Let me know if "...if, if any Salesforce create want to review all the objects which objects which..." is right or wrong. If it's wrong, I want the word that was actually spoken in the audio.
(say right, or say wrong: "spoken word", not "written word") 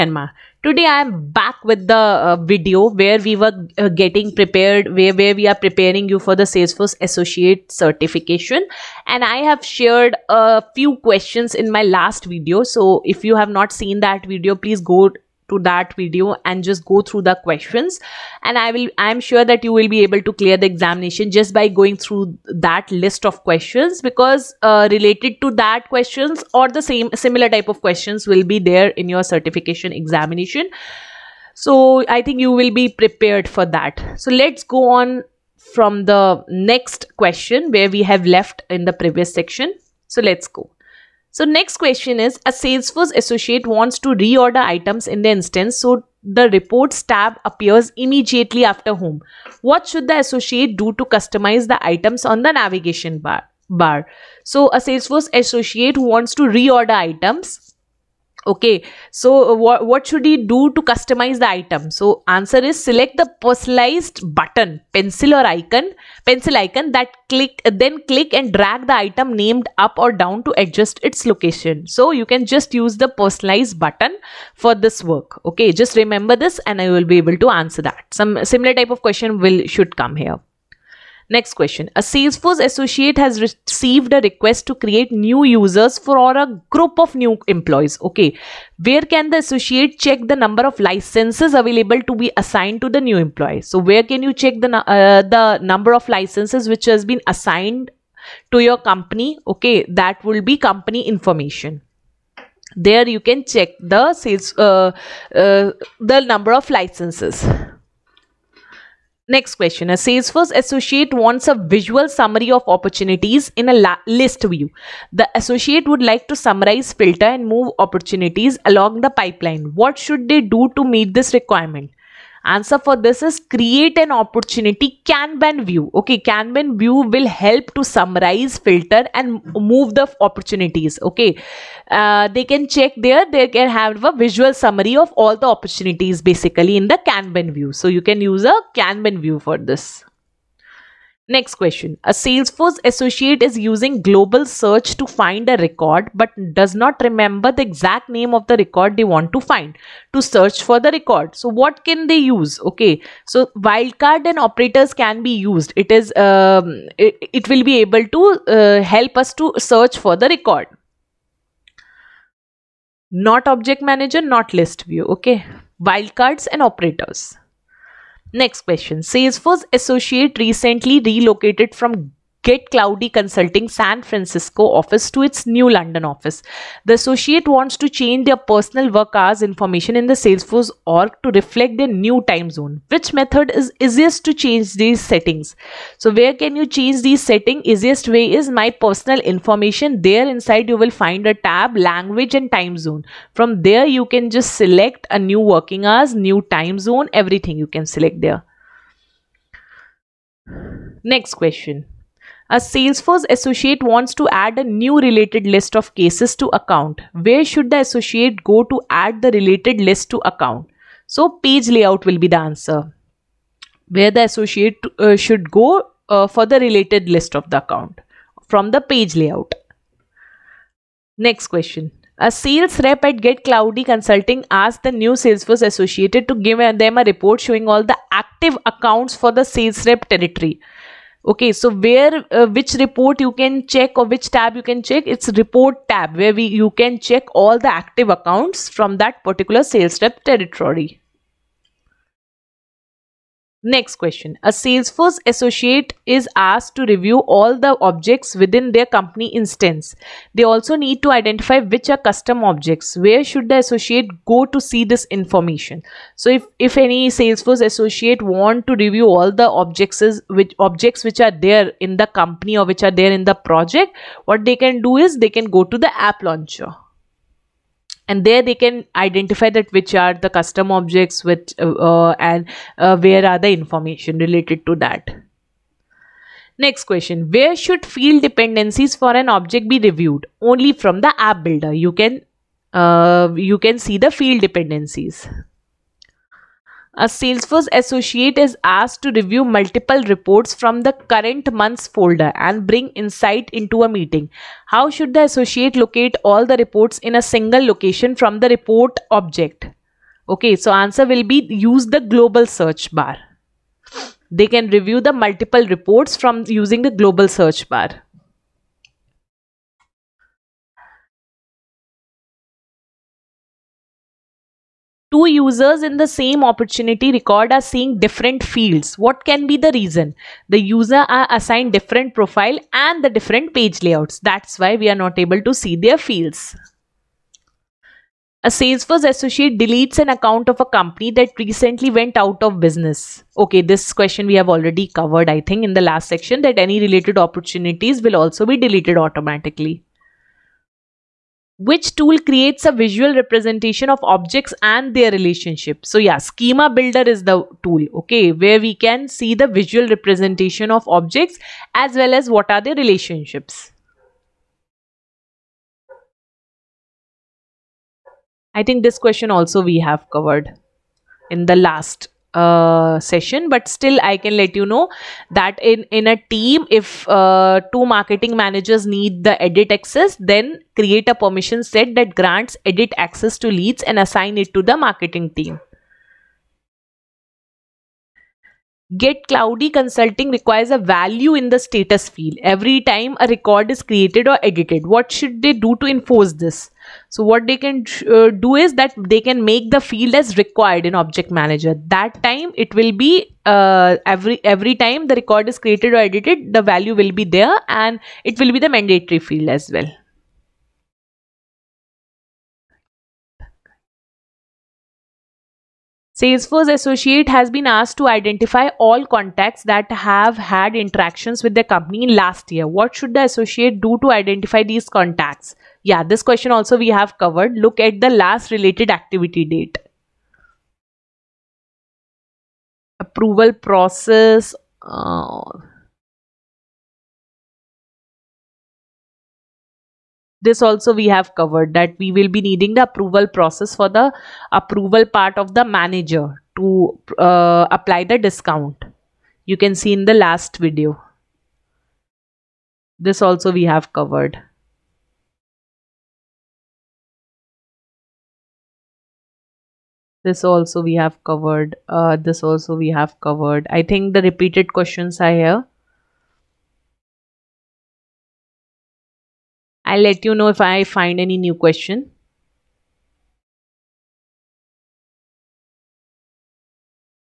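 wrong: "associate", not "create".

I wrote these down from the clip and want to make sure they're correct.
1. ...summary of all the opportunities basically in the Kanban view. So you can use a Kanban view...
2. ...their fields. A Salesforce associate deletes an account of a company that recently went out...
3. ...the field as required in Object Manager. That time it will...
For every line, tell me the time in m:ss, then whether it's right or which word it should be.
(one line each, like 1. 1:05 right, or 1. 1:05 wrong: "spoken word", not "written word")
1. 2:14 right
2. 5:25 right
3. 6:29 right.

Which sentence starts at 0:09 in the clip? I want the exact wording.
And I have shared a few questions in my last video.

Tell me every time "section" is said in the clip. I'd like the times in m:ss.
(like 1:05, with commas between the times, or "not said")
0:39, 5:36.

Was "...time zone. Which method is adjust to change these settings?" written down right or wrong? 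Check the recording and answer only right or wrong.
wrong.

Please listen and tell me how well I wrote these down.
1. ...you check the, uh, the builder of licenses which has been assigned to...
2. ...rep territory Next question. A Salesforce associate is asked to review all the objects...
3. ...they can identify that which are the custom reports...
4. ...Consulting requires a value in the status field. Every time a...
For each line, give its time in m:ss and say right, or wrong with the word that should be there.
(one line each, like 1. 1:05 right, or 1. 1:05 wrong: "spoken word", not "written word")
1. 1:34 wrong: "number", not "builder"
2. 4:00 right
3. 4:28 wrong: "objects", not "reports"
4. 6:19 right.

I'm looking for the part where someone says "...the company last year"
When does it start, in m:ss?
6:51.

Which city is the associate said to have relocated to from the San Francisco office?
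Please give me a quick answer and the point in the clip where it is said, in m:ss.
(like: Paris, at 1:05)
London, at 2:55.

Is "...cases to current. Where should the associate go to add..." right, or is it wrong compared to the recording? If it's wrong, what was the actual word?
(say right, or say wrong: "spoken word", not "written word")
wrong: "account", not "current".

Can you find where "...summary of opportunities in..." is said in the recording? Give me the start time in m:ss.
1:52.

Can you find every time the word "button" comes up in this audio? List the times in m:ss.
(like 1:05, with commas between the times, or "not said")
1:04, 1:13.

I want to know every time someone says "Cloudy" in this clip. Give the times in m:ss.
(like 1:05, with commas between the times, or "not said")
2:52, 3:43, 6:19.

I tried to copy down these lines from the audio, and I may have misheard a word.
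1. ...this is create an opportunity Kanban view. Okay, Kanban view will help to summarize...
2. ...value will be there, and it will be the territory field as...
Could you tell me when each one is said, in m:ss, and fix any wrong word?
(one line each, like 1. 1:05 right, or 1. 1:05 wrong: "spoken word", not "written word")
1. 2:02 right
2. 6:36 wrong: "mandatory", not "territory".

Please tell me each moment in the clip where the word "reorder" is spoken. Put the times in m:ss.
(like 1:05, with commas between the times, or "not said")
0:44, 0:56.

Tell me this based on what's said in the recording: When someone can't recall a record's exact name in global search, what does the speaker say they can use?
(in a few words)
Wildcards and operators.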